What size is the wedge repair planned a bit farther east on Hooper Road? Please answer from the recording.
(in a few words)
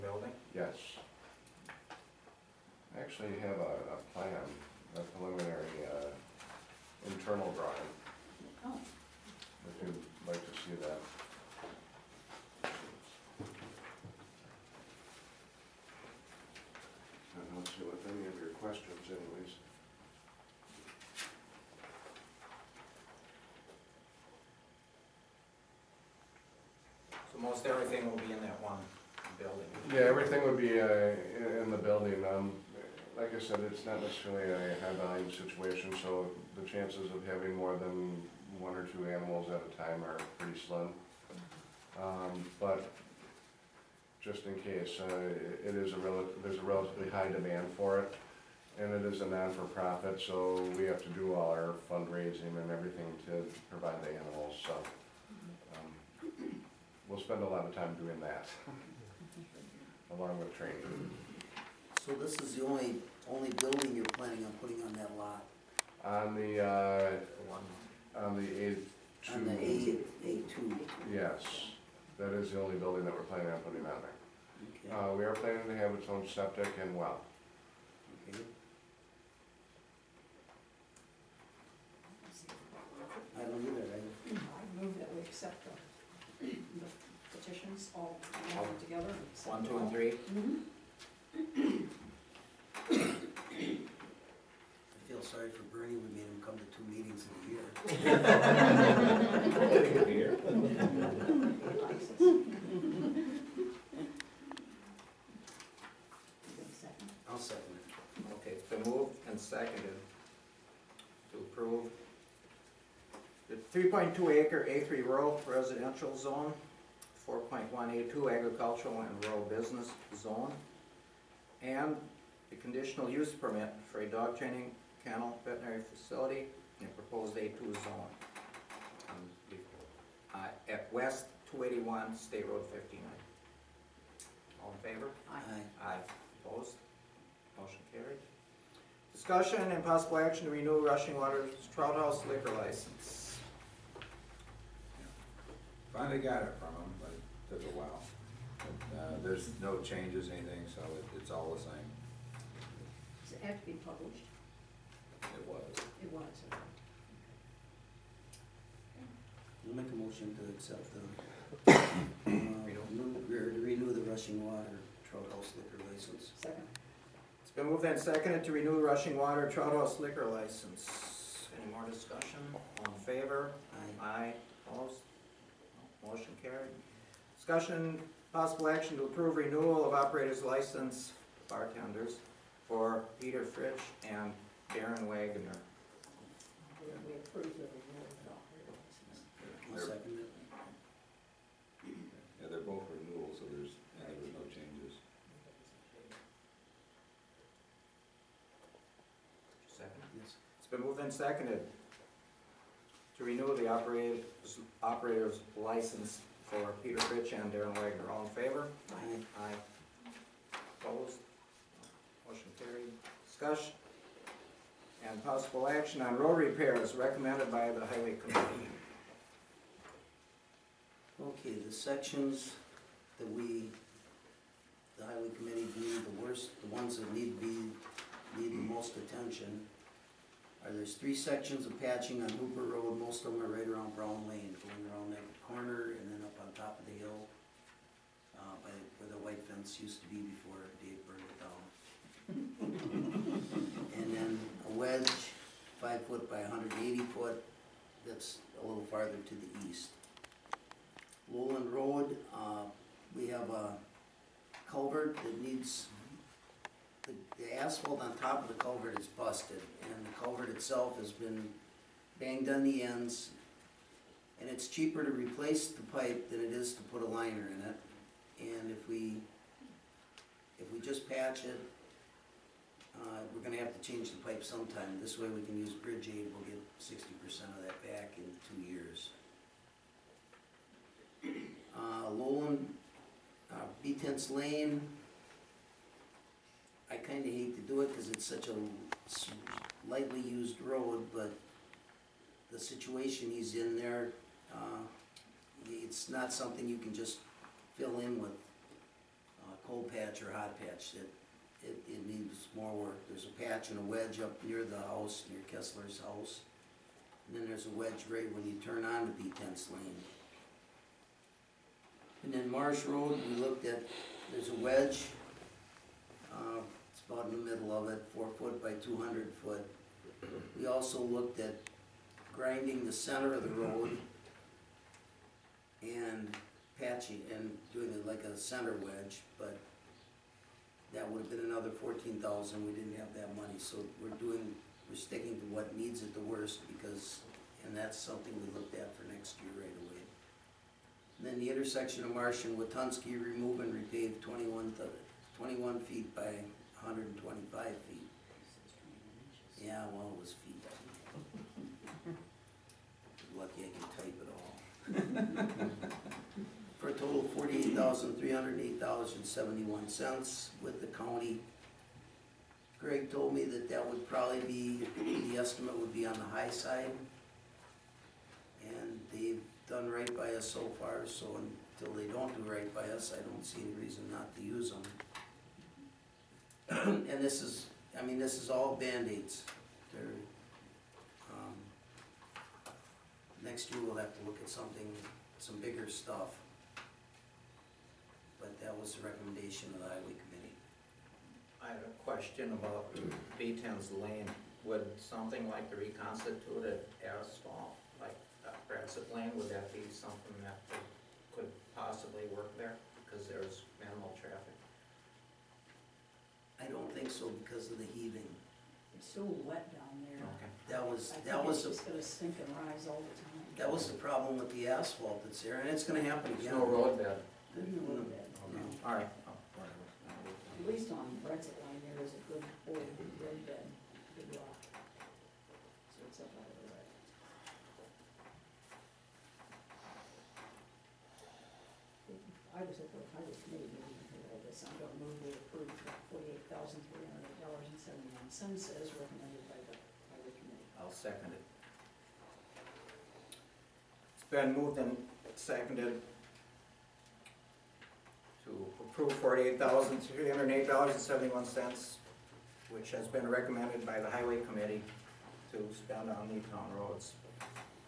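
5 feet by 180 feet.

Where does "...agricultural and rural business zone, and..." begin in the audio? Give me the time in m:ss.
1:58.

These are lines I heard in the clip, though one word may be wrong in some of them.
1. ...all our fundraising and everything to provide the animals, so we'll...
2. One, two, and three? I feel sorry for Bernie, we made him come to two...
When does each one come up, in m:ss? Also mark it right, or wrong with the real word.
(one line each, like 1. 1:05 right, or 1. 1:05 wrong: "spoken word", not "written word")
1. 0:51 right
2. 1:29 right.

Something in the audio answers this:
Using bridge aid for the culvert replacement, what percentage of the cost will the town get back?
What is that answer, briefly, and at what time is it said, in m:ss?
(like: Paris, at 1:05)
60 percent, at 4:36.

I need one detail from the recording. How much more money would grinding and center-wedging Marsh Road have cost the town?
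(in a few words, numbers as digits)
14,000.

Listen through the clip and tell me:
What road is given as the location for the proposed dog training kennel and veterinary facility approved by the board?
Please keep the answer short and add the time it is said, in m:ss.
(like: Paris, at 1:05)
West 281 State Road 59, at 2:10.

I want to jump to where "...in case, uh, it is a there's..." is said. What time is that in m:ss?
0:44.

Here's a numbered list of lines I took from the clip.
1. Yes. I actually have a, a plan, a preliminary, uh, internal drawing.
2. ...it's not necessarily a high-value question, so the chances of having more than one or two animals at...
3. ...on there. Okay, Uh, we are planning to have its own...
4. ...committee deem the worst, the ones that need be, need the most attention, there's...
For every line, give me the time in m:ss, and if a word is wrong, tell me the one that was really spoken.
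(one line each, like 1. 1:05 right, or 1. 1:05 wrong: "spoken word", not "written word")
1. 0:00 right
2. 0:33 wrong: "situation", not "question"
3. 1:13 right
4. 3:45 right.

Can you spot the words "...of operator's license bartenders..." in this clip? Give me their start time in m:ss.
2:59.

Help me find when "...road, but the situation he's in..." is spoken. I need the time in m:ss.
4:50.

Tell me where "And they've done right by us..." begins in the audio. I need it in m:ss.
6:08.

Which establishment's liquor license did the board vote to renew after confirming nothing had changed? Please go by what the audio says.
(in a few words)
Rushing Waters Trout House.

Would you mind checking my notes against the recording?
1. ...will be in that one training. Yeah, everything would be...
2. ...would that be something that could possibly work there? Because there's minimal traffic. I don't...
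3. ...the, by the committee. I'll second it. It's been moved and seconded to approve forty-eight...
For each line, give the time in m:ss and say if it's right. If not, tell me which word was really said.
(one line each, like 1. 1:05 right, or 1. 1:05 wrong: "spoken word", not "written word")
1. 0:28 wrong: "building", not "training"
2. 6:39 right
3. 7:19 right.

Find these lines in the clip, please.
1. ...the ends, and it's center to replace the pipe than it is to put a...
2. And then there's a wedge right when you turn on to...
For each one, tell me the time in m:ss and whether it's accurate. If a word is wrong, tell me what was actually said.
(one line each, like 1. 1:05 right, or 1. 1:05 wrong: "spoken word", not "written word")
1. 4:22 wrong: "cheaper", not "center"
2. 5:07 right.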